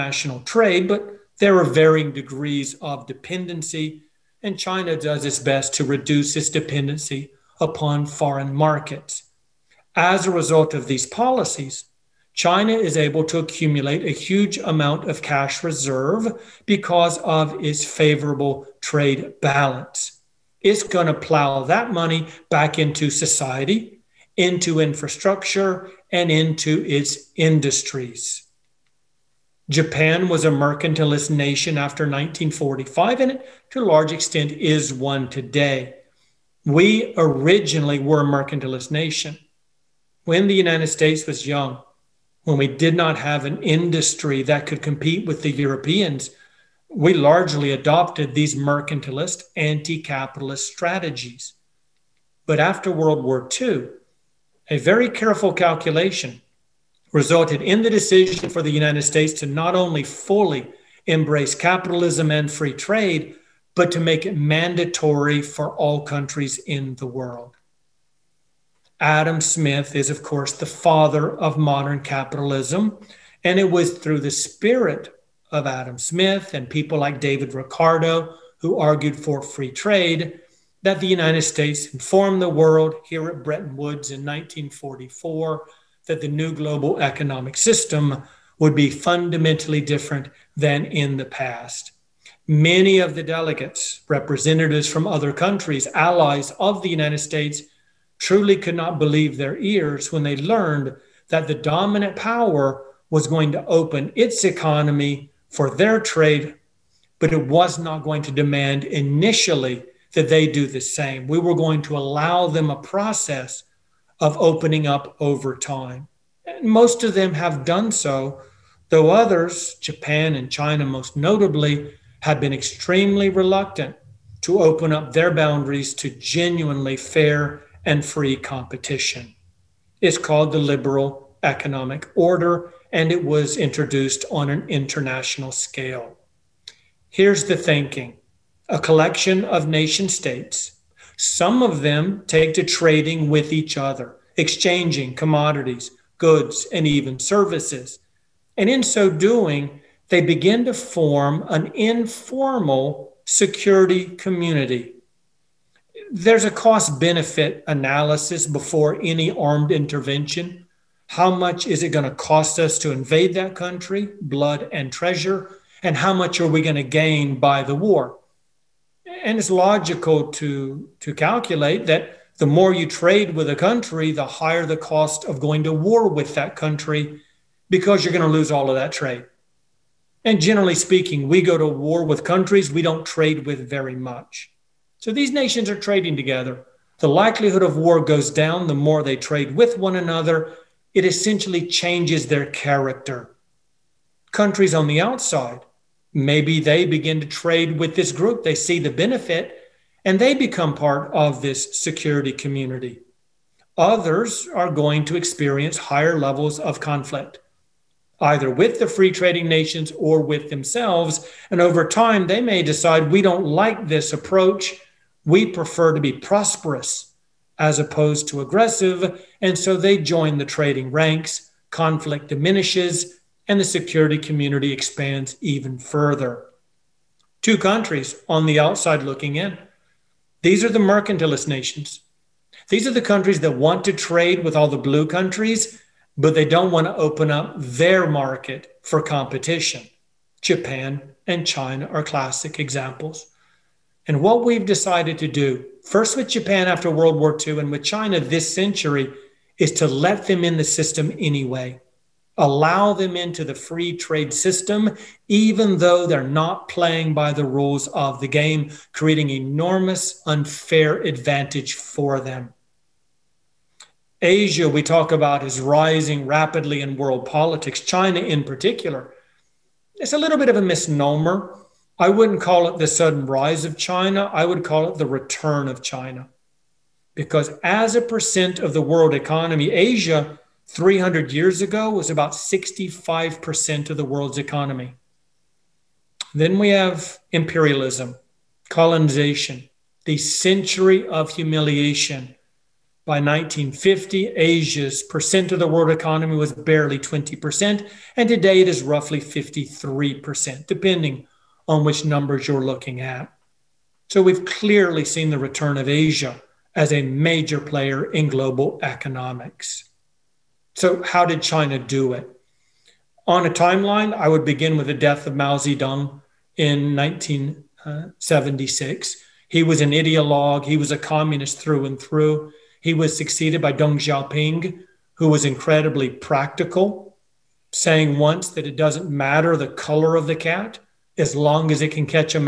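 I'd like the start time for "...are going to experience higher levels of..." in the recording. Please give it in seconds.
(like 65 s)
204 s.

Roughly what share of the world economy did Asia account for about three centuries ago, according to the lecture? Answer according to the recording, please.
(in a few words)
65%.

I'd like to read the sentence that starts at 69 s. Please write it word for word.
Adam Smith is, of course, the father of modern capitalism.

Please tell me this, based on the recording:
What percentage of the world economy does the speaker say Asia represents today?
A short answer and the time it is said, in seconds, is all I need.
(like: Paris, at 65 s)
53%, at 299 s.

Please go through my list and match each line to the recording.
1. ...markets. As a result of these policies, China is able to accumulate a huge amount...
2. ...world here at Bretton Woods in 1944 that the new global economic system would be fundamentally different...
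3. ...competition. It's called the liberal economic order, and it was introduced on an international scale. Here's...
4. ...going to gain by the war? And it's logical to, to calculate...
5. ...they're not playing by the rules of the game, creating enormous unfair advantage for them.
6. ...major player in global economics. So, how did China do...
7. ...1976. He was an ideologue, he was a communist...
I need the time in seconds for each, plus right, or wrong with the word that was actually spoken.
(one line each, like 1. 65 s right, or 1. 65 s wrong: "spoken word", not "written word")
1. 8 s right
2. 82 s right
3. 128 s right
4. 166 s right
5. 256 s right
6. 307 s right
7. 316 s right.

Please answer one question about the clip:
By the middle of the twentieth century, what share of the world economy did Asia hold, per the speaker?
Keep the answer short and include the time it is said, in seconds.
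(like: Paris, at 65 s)
20%, at 296 s.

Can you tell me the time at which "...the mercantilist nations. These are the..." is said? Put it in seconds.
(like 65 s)
230 s.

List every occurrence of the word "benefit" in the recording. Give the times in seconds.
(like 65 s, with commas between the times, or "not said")
156 s, 198 s.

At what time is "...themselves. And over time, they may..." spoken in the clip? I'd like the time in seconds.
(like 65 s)
210 s.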